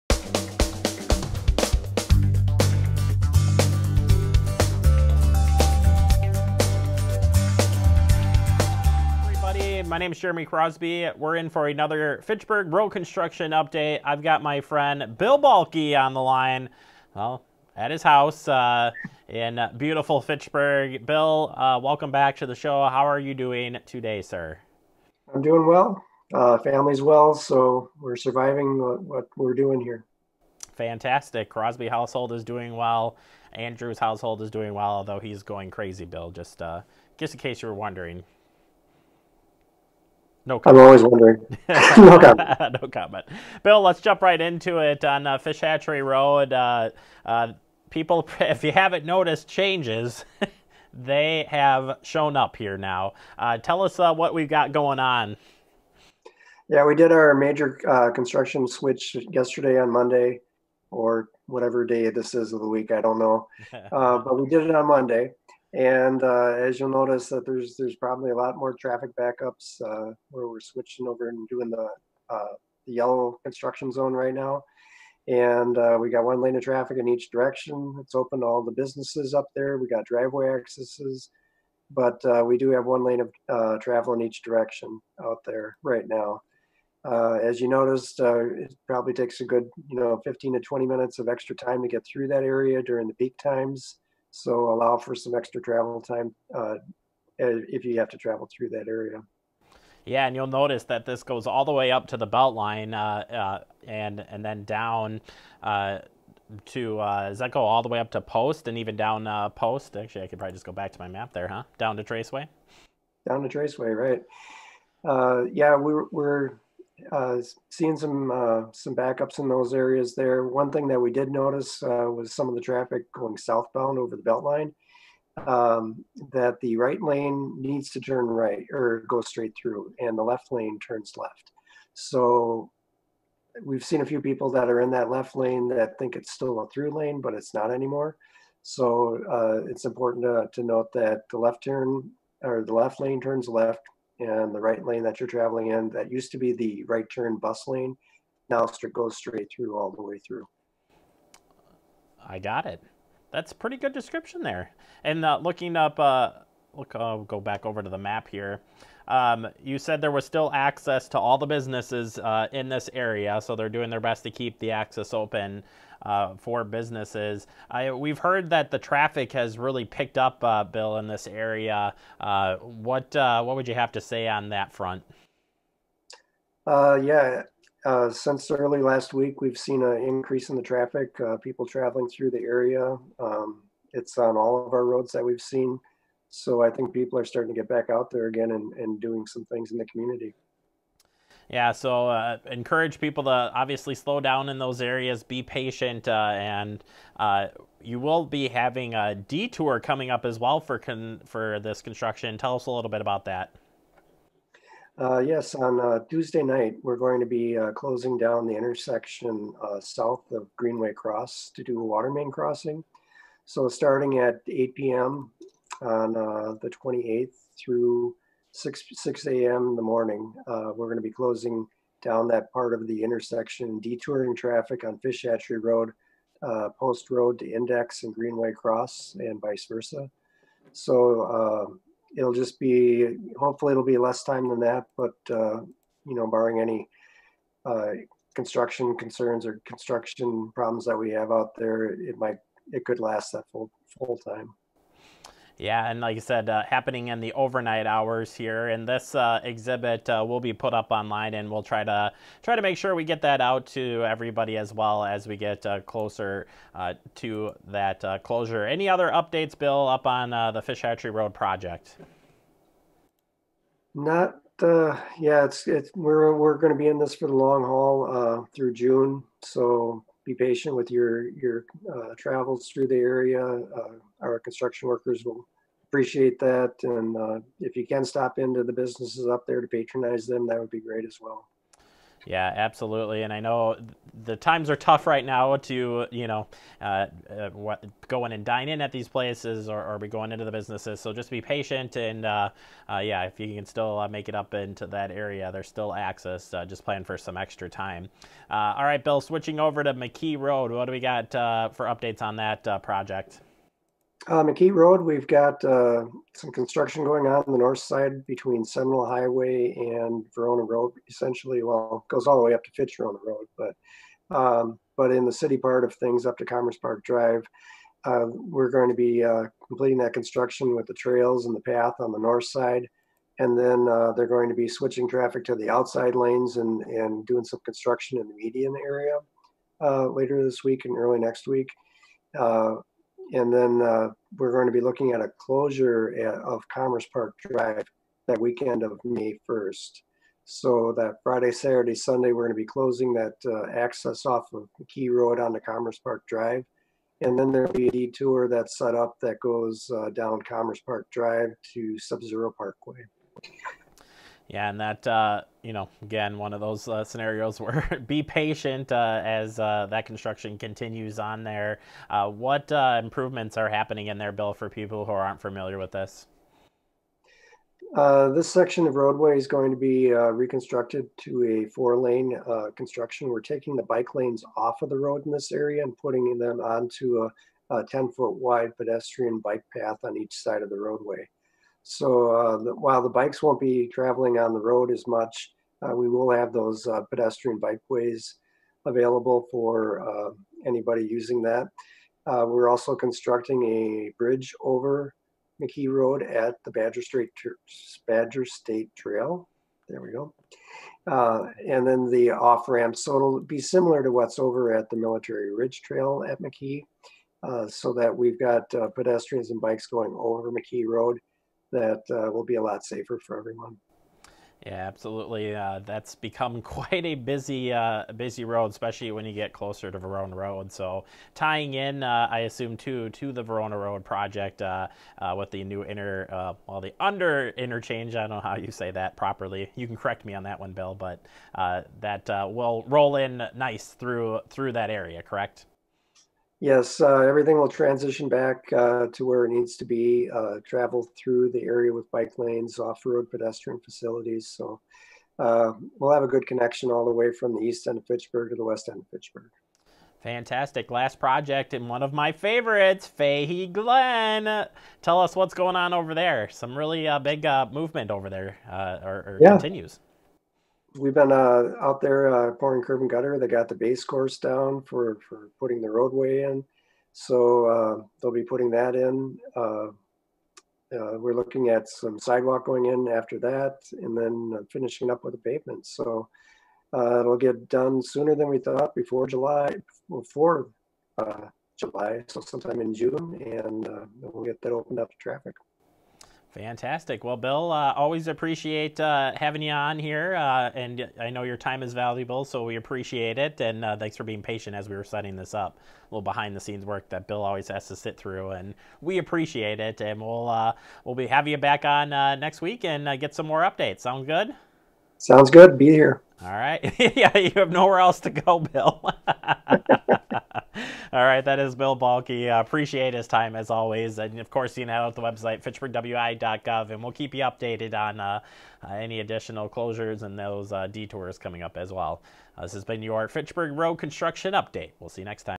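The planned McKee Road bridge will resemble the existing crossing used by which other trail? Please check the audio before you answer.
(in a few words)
Military Ridge Trail.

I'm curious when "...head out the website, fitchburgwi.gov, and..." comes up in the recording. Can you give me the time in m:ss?
8:34.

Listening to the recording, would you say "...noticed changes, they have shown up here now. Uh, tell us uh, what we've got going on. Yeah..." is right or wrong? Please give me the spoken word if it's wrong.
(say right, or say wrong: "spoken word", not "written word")
right.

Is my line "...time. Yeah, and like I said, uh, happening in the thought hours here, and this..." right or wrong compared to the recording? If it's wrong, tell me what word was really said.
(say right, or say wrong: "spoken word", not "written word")
wrong: "overnight", not "thought".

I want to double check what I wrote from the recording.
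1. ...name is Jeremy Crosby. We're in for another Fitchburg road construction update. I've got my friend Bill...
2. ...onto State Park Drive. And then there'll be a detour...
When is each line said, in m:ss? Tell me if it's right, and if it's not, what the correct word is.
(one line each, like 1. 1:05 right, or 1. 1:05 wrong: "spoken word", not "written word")
1. 0:09 right
2. 5:45 wrong: "Commerce", not "State".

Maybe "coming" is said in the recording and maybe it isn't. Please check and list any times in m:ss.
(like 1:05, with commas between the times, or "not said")
3:19, 8:41.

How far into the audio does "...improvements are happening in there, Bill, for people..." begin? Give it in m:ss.
6:03.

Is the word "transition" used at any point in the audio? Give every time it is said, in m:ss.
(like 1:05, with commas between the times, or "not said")
7:17.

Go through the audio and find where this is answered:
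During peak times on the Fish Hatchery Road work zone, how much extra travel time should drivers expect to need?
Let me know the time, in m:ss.
1:30.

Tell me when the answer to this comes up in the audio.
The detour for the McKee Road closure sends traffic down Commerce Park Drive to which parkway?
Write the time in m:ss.
5:51.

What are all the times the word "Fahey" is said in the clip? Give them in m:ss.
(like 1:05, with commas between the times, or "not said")
7:33.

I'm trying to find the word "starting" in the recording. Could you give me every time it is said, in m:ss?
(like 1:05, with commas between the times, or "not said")
3:07, 3:33.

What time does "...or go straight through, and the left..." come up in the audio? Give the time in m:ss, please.
2:08.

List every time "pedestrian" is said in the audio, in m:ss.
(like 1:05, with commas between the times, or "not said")
6:18, 6:27, 6:48, 7:23.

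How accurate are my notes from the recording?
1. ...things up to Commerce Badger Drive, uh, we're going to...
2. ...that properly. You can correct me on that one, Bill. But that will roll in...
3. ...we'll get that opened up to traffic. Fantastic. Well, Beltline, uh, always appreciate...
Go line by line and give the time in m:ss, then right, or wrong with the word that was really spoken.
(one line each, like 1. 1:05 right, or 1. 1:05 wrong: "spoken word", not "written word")
1. 5:15 wrong: "Park", not "Badger"
2. 7:08 right
3. 8:04 wrong: "Bill", not "Beltline".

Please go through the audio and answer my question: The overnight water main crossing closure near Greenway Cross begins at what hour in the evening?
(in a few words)
8 p.m.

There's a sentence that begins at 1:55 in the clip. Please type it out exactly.
Uh, yeah, we're we're uh, seeing some uh, some backups in those areas there.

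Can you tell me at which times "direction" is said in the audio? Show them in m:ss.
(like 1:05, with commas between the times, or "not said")
1:17, 1:24.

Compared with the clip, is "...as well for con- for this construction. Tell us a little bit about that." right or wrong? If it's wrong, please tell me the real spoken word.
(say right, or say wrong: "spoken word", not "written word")
right.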